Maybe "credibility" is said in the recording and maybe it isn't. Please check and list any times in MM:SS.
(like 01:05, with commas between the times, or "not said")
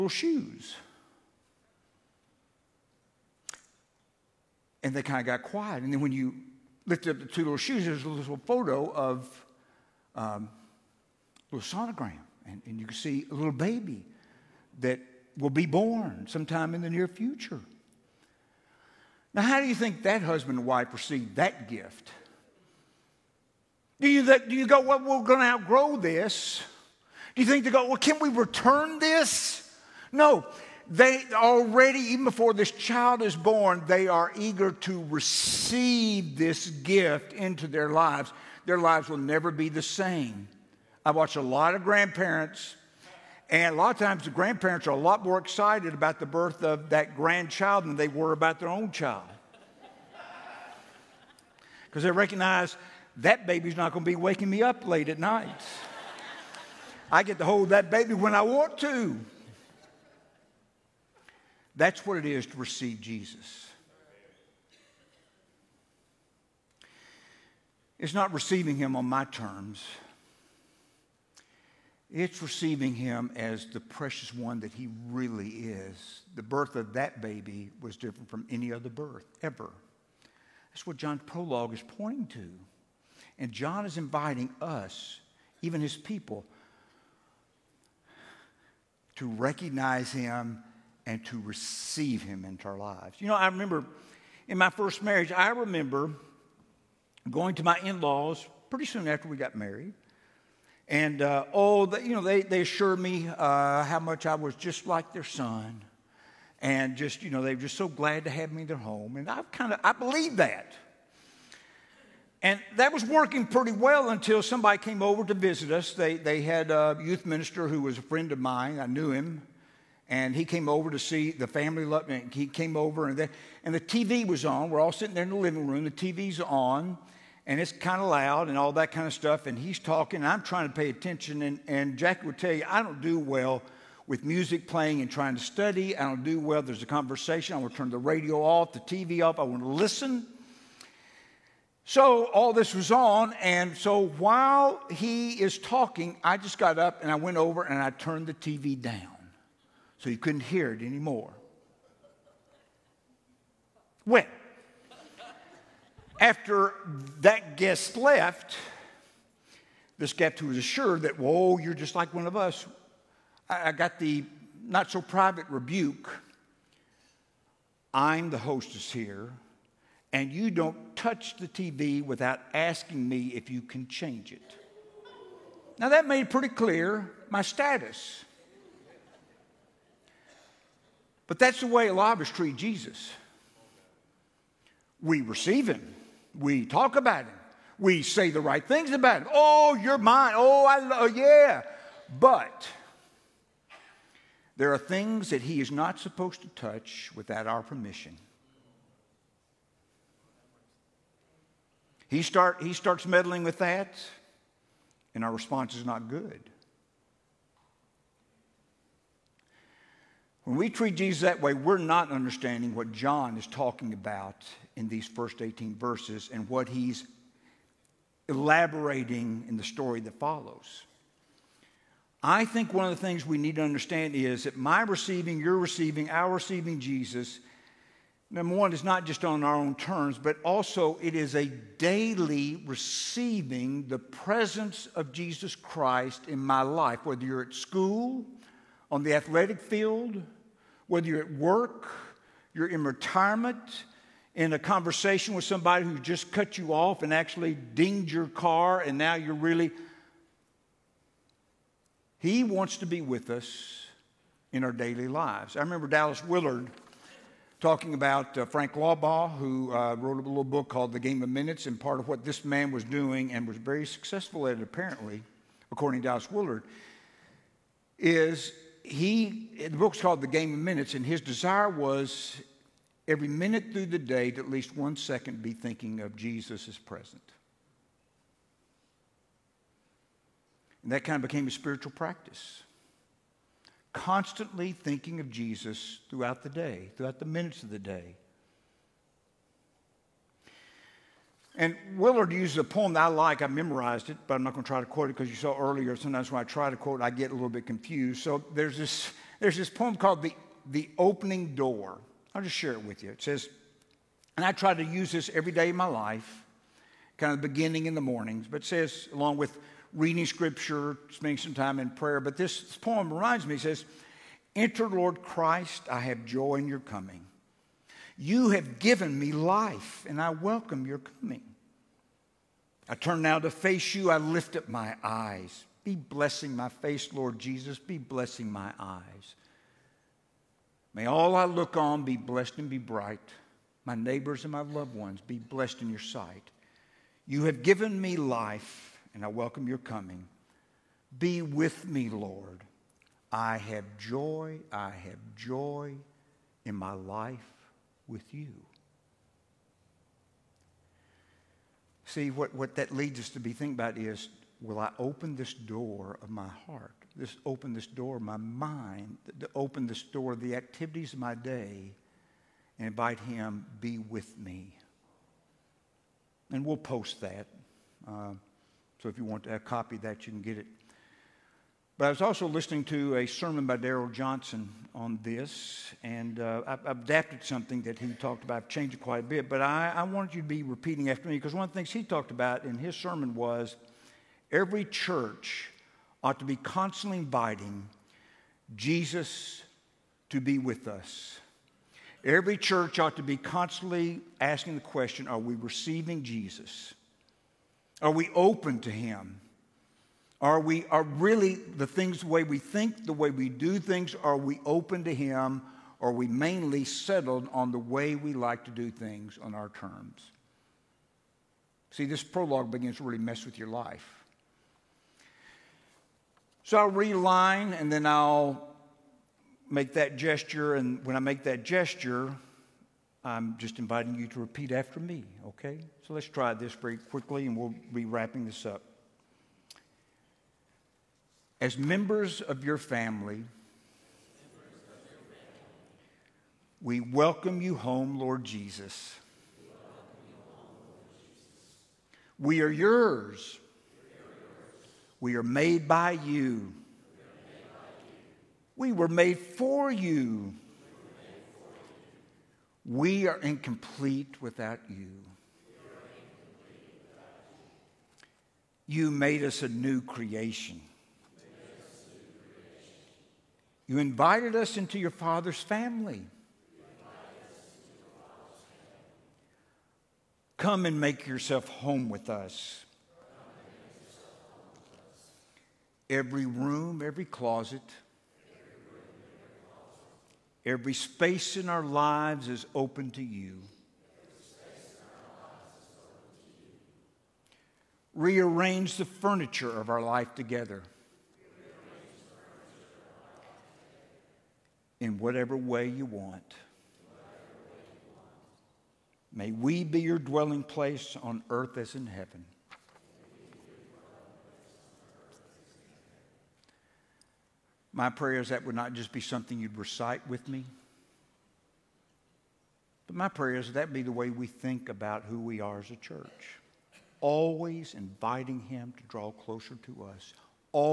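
not said.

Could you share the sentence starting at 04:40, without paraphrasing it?
And that kind of became a spiritual practice.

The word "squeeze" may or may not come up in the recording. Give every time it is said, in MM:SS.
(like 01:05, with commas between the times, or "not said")
not said.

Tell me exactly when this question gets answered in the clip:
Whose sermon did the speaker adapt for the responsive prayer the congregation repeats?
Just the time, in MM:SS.
06:13.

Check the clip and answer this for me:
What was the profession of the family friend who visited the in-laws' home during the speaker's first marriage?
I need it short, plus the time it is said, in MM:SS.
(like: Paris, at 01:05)
youth minister, at 01:56.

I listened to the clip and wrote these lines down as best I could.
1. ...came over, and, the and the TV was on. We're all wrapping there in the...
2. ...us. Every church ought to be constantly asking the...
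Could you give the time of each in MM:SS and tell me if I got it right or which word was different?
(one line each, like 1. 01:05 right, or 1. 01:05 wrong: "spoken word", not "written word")
1. 02:02 wrong: "sitting", not "wrapping"
2. 06:30 right.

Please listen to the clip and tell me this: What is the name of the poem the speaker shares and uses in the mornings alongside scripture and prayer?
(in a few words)
The Opening Door.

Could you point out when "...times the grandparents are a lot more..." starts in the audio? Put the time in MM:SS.
00:43.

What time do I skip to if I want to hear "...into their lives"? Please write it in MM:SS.
00:37.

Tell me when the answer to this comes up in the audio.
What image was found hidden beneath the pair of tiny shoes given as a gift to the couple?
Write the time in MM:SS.
00:11.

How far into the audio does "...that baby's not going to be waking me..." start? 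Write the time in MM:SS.
00:53.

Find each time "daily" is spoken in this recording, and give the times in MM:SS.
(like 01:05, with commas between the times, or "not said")
03:51, 04:14.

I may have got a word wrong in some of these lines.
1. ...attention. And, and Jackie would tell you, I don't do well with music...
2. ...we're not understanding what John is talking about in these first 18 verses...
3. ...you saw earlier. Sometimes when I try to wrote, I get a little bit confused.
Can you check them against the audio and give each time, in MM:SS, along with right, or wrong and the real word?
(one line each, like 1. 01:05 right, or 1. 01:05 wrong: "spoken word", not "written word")
1. 02:10 right
2. 03:31 right
3. 04:55 wrong: "quote", not "wrote".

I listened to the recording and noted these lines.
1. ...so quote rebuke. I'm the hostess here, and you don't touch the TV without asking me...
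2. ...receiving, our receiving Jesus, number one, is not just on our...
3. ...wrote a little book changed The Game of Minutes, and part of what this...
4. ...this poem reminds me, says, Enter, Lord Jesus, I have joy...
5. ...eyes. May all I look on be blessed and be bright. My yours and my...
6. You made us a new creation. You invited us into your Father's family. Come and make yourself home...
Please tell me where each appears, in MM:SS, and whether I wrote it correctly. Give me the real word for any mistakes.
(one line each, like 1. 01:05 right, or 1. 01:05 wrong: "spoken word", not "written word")
1. 02:44 wrong: "private", not "quote"
2. 03:45 right
3. 04:19 wrong: "called", not "changed"
4. 05:12 wrong: "Christ", not "Jesus"
5. 05:28 wrong: "neighbors", not "yours"
6. 07:38 right.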